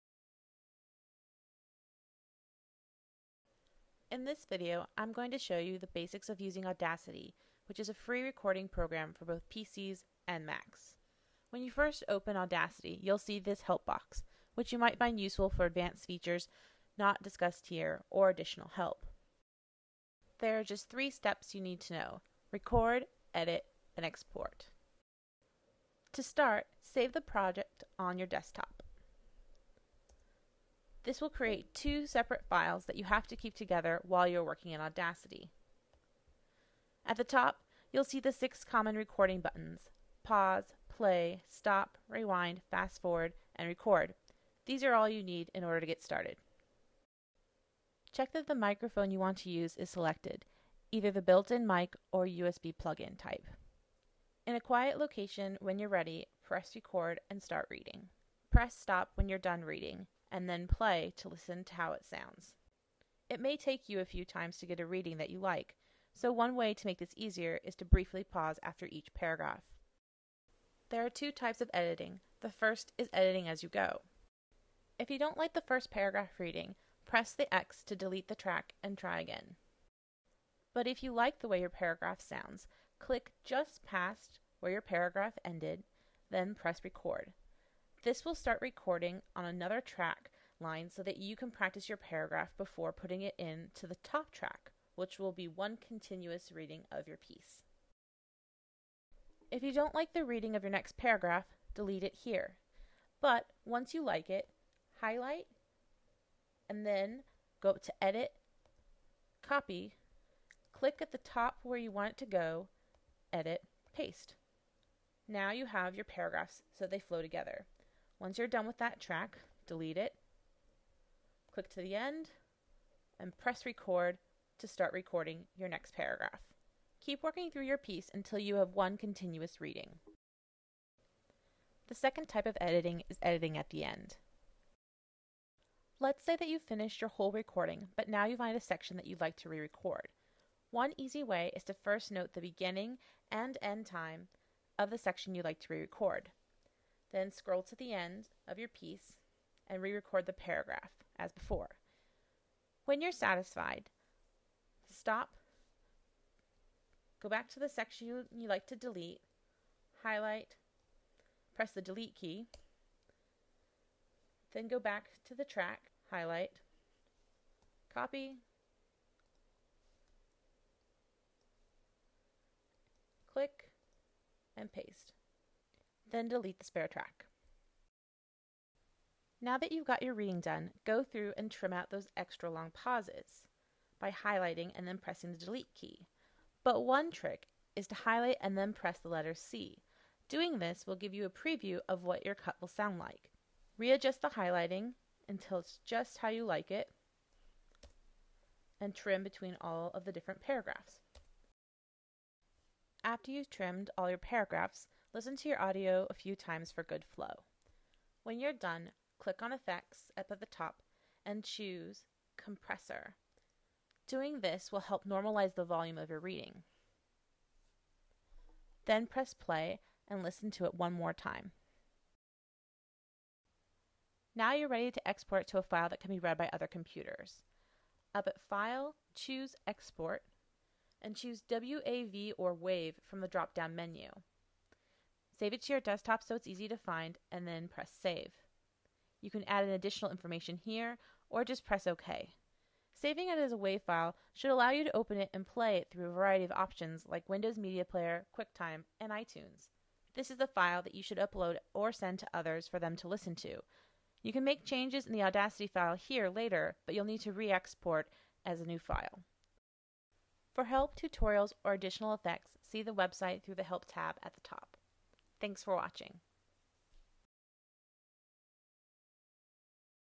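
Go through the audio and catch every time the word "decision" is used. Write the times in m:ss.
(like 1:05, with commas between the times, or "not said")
not said.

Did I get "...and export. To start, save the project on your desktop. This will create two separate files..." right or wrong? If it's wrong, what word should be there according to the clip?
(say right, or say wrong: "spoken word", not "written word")
right.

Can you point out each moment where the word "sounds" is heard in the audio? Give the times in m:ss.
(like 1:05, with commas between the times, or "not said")
1:02, 1:22, 3:12.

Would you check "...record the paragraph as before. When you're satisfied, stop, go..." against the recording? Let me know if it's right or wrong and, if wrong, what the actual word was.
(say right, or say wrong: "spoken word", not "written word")
right.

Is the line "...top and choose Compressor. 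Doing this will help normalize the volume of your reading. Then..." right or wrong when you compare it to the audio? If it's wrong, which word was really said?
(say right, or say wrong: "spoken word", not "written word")
right.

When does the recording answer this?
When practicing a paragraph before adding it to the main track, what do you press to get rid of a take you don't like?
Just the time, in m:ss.
1:17.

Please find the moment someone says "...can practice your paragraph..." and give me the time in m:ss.
1:31.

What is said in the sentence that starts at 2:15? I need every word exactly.
Let's say that you've finished your whole recording, but now you find a section that you'd like to re record.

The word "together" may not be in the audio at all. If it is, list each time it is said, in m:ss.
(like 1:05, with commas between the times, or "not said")
0:33, 1:57.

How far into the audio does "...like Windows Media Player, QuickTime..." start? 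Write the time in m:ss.
4:07.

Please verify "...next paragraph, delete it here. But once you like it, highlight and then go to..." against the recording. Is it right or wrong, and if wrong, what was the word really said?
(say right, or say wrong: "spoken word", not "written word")
right.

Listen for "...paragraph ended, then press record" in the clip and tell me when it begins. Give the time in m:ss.
1:24.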